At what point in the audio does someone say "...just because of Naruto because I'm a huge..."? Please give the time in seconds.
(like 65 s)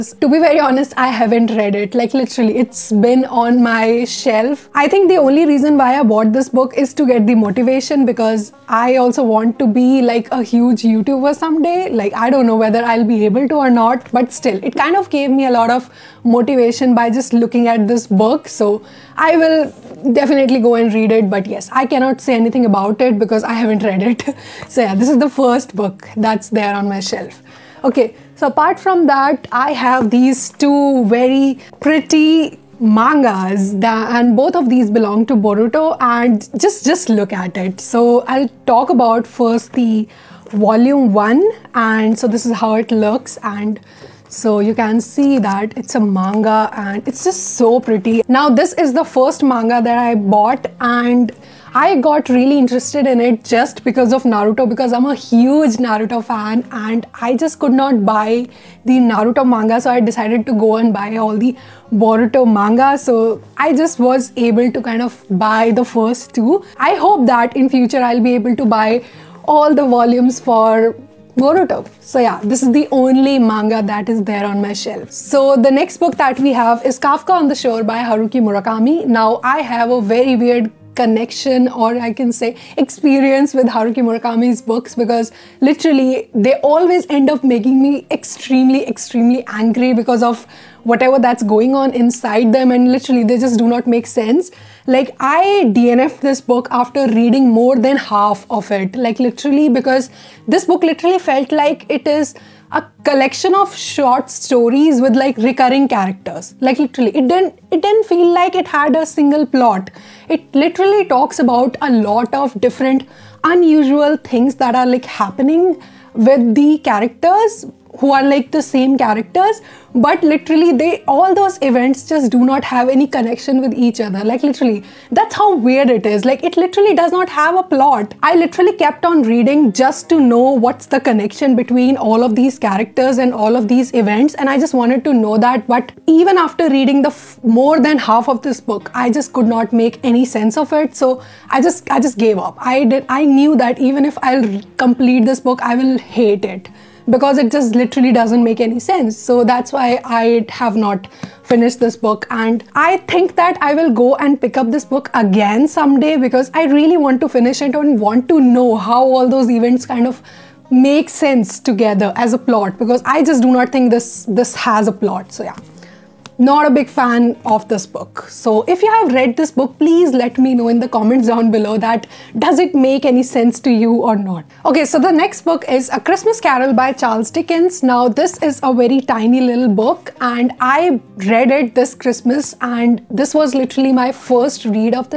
53 s.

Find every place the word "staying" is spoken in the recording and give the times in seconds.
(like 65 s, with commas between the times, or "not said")
not said.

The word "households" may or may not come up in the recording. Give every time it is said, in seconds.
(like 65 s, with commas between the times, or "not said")
not said.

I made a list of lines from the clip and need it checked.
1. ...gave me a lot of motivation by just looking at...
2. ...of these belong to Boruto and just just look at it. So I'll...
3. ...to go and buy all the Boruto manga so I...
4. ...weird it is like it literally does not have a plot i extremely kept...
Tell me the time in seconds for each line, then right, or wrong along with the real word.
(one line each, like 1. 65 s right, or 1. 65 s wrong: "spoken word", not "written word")
1. 15 s right
2. 34 s right
3. 60 s right
4. 125 s wrong: "literally", not "extremely".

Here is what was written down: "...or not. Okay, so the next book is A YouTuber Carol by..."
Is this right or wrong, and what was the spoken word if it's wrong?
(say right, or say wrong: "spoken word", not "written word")
wrong: "Christmas", not "YouTuber".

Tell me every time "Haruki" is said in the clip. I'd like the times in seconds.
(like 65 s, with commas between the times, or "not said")
77 s, 83 s.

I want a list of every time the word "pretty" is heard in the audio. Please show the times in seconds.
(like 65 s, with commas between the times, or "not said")
31 s, 47 s.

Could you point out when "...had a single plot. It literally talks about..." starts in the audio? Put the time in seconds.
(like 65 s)
108 s.